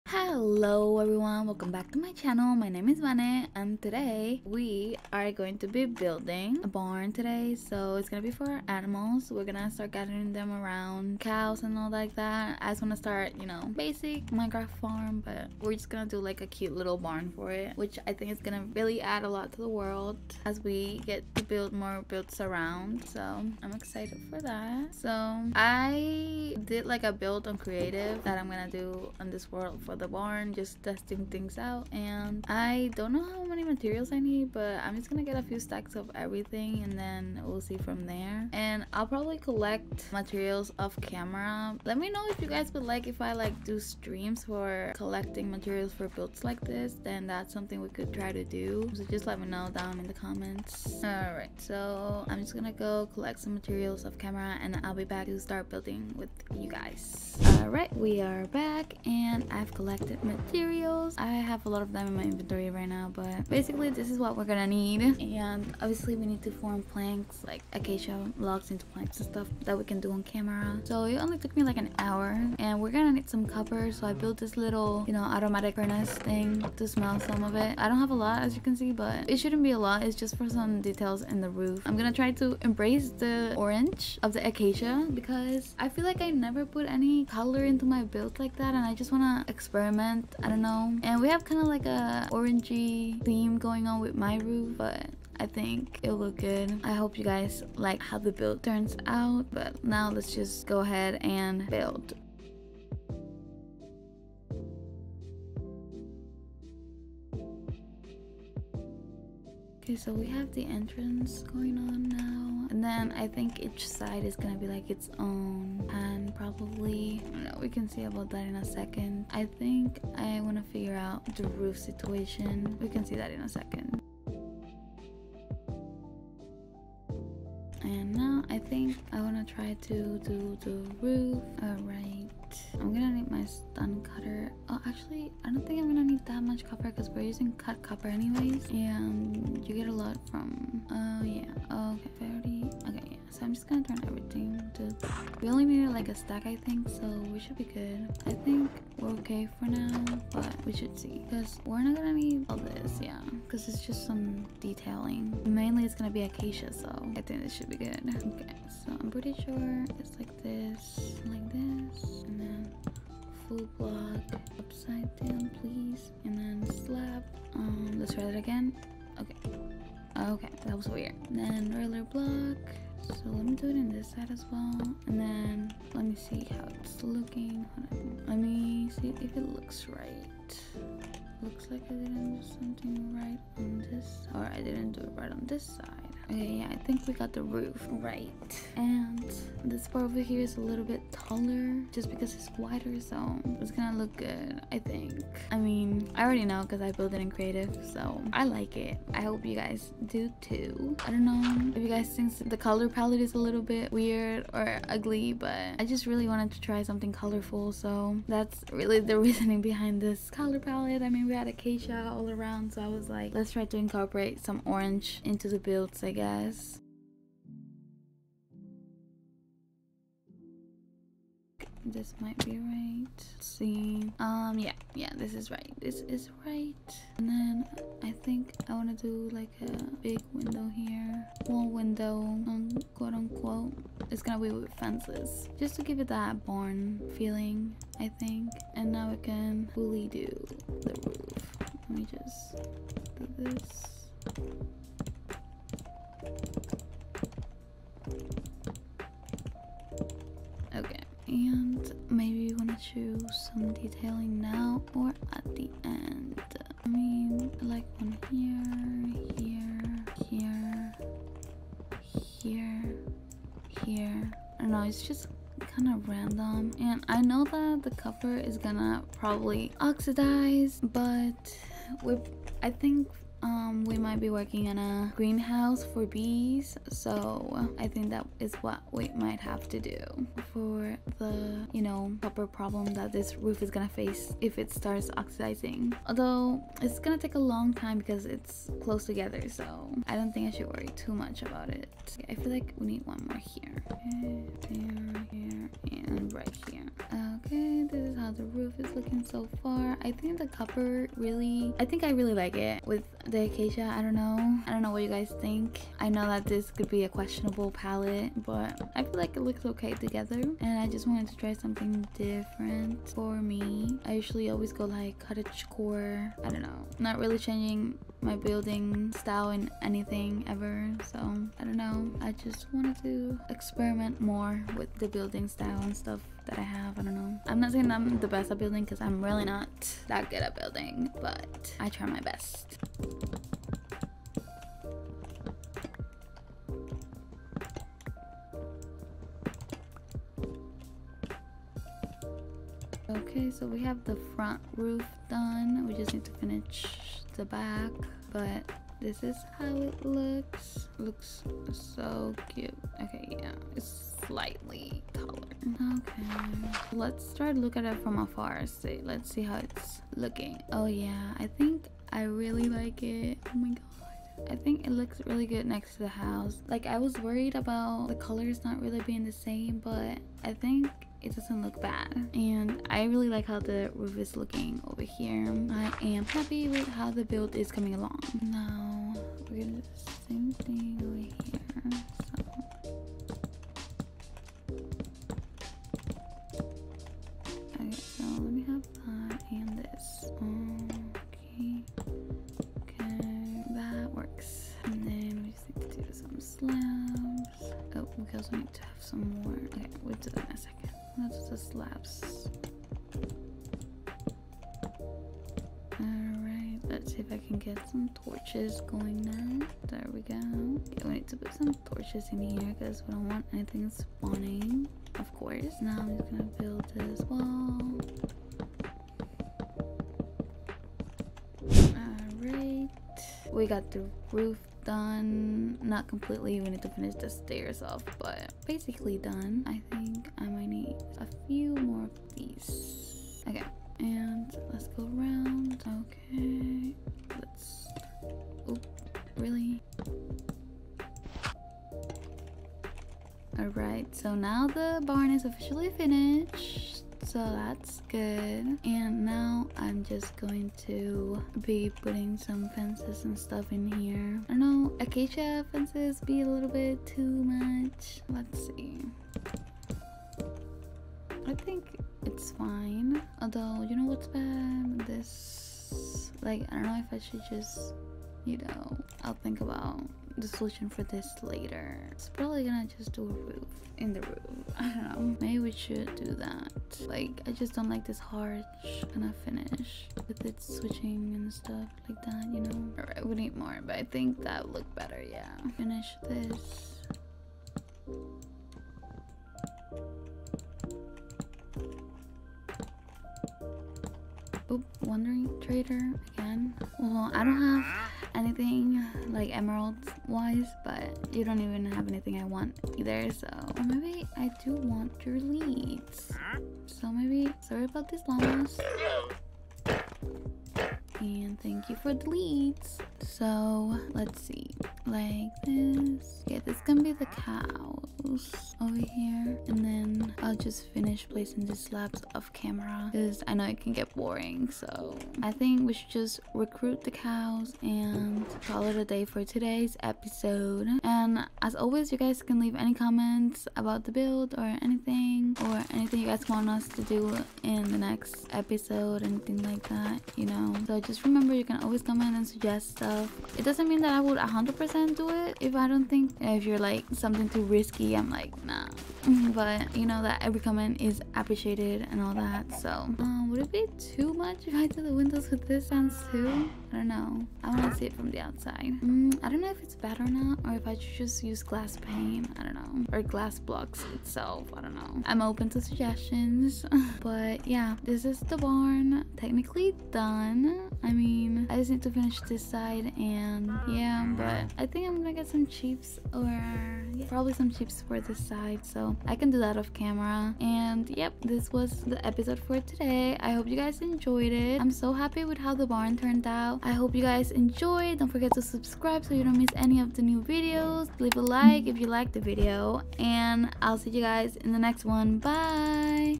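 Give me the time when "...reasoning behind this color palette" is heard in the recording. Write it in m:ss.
3:29.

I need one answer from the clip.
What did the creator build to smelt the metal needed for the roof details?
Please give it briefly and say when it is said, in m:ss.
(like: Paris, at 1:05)
automatic furnace, at 1:15.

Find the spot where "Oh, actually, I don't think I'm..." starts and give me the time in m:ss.
2:14.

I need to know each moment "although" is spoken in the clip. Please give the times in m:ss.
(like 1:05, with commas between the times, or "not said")
4:46, 7:43.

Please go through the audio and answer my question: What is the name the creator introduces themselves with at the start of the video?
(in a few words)
Vane.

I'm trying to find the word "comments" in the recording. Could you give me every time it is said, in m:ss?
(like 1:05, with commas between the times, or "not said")
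0:50, 8:52, 9:02, 9:10.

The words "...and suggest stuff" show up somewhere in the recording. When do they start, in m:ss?
9:02.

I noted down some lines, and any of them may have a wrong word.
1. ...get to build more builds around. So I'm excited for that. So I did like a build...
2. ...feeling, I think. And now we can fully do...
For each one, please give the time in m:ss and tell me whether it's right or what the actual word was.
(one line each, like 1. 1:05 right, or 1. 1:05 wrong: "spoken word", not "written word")
1. 0:21 right
2. 3:57 right.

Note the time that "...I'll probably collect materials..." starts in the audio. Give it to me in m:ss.
0:38.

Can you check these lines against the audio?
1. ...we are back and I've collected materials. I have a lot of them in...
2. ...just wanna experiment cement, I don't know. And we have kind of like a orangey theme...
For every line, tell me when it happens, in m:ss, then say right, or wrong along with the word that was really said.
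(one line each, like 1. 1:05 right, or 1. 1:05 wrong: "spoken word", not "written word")
1. 0:57 right
2. 1:28 right.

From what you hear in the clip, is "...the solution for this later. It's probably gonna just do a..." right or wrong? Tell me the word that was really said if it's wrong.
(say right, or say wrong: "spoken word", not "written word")
right.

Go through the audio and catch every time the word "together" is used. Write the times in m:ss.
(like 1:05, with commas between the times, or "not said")
4:49, 5:09.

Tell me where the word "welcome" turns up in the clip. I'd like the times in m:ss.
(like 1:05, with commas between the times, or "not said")
0:01.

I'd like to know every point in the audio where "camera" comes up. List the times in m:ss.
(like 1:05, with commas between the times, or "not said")
0:41, 0:54, 1:10, 8:42, 9:39.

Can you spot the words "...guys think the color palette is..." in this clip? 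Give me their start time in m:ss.
3:21.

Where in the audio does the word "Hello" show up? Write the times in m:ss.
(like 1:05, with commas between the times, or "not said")
0:00.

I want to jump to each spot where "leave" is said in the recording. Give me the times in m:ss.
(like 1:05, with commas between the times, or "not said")
8:52, 9:51.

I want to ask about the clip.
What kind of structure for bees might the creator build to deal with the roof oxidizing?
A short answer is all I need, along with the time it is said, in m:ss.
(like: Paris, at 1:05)
greenhouse, at 4:35.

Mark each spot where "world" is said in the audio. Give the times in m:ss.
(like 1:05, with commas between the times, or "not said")
0:19, 0:29.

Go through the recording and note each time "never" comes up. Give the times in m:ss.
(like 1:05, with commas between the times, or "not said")
1:26.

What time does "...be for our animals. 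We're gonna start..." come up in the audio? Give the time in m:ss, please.
0:08.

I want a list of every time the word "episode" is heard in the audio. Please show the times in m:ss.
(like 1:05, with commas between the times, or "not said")
8:50, 8:58, 9:42.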